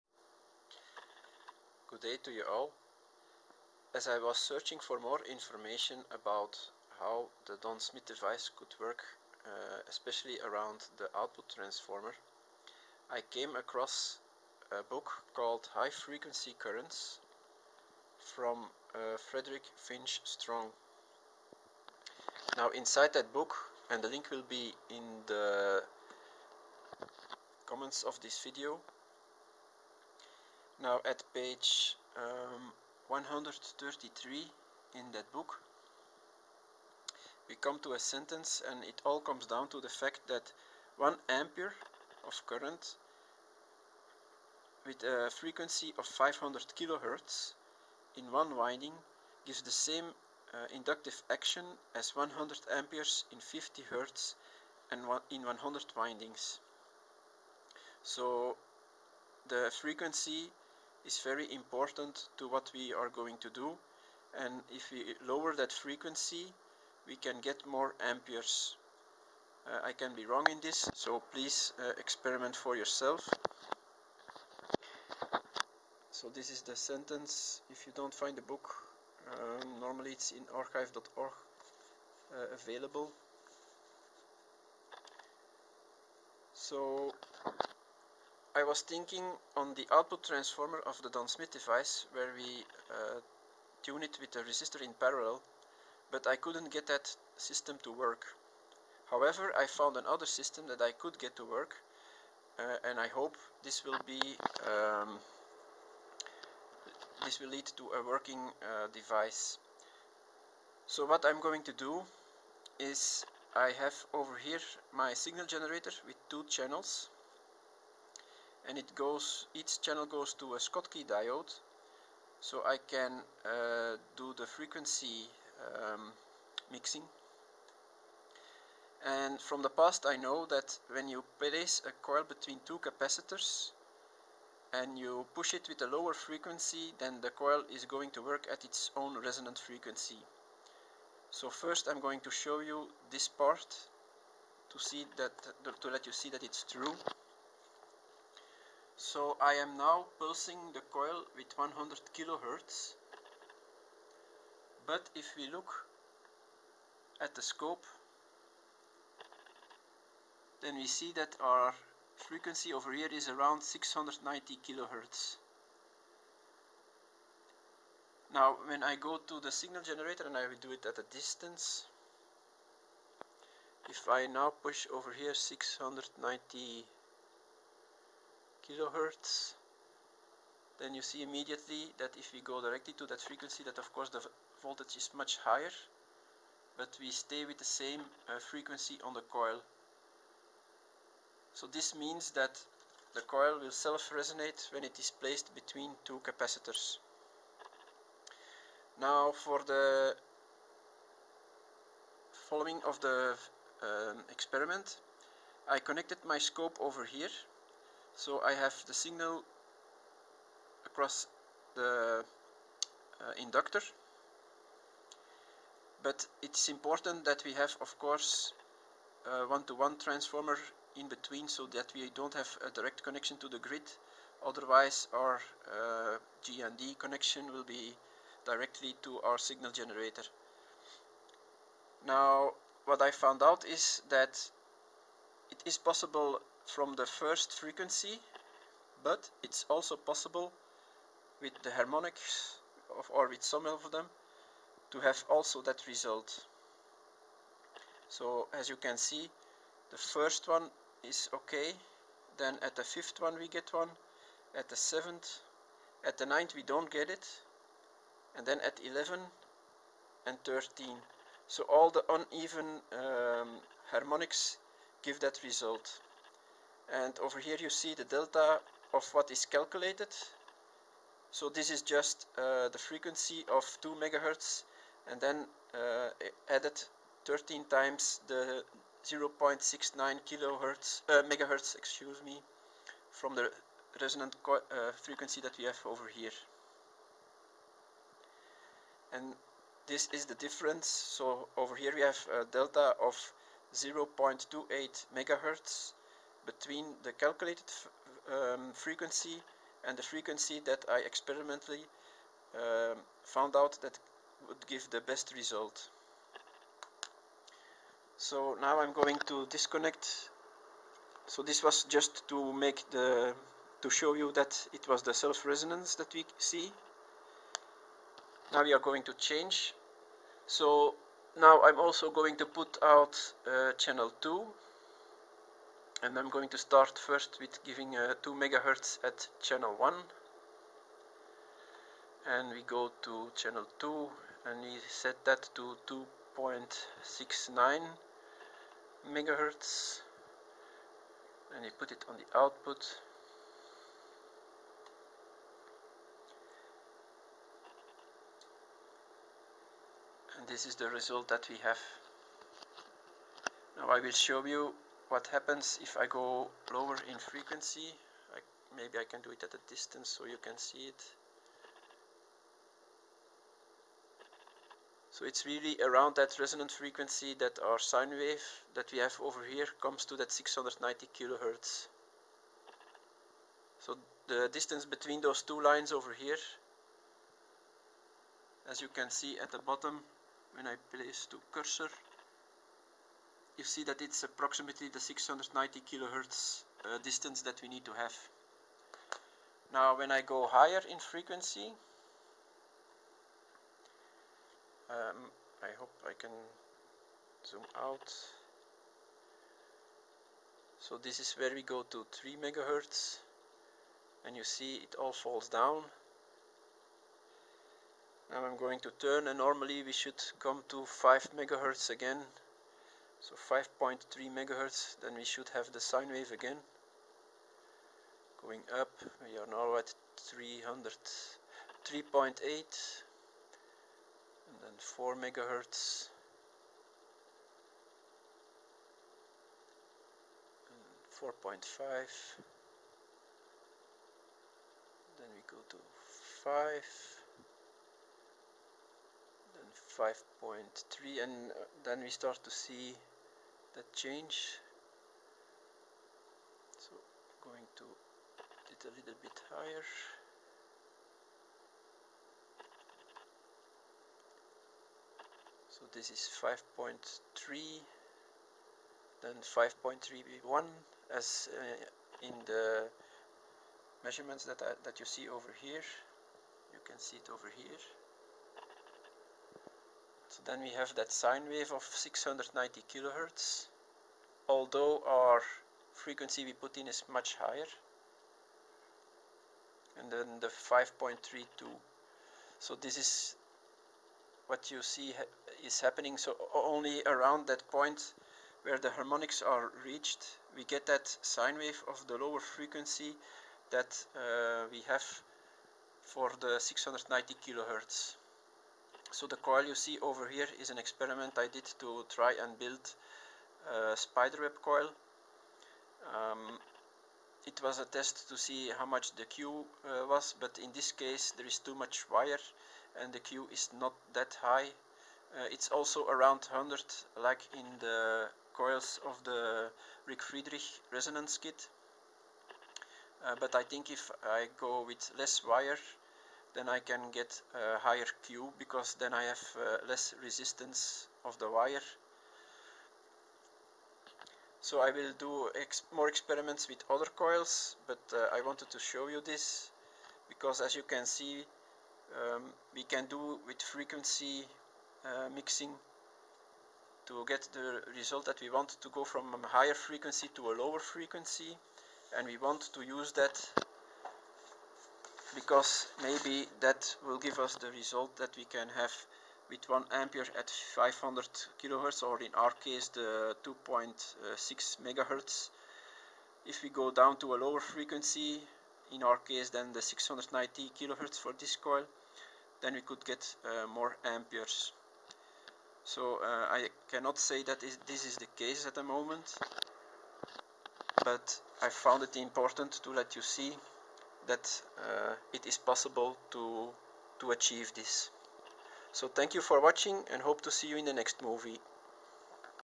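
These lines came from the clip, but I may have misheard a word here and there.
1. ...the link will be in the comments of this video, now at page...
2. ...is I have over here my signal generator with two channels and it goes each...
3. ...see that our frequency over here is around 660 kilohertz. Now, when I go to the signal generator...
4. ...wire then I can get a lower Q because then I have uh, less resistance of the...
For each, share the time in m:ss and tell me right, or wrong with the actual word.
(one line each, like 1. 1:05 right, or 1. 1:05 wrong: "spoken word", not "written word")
1. 0:24 right
2. 1:52 right
3. 2:40 wrong: "690", not "660"
4. 8:45 wrong: "higher", not "lower".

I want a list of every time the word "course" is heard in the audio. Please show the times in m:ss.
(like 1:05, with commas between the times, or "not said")
3:03, 3:37.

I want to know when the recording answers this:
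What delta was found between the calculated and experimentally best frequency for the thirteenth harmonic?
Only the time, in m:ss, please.
4:53.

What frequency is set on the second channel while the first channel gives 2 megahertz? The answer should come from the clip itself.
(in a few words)
2.69 megahertz.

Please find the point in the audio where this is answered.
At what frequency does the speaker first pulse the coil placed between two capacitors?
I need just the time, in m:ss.
2:31.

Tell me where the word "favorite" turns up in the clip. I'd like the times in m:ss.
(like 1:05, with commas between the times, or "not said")
not said.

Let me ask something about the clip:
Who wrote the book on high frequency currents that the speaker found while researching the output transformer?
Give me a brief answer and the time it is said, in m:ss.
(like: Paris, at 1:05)
Frederick Finch Strong, at 0:19.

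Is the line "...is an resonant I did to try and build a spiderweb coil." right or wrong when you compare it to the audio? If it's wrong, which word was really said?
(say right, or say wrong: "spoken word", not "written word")
wrong: "experiment", not "resonant".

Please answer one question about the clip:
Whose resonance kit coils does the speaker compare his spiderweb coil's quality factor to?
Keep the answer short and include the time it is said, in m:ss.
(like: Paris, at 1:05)
Rick Friedrich, at 8:40.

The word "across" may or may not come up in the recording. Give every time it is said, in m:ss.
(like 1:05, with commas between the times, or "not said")
0:13, 3:30.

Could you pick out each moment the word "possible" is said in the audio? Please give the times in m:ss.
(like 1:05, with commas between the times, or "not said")
3:55, 3:59, 9:45.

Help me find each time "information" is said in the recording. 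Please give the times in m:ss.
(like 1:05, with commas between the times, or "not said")
0:05.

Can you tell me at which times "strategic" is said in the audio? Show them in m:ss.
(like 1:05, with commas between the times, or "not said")
not said.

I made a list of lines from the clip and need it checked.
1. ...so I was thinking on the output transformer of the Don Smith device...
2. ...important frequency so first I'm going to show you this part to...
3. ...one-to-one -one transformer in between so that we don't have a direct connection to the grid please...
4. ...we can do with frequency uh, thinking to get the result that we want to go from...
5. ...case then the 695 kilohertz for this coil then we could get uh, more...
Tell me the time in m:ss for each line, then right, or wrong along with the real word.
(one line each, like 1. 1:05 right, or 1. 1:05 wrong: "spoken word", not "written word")
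1. 1:26 right
2. 2:19 wrong: "resonant", not "important"
3. 3:39 wrong: "otherwise", not "please"
4. 9:02 wrong: "mixing", not "thinking"
5. 9:29 wrong: "690", not "695".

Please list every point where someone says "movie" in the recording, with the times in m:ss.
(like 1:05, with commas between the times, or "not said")
9:51.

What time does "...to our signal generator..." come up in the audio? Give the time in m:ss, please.
3:49.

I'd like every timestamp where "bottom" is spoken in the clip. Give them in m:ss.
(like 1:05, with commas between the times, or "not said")
6:19.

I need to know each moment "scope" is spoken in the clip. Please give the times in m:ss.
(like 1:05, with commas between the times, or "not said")
2:37, 3:26.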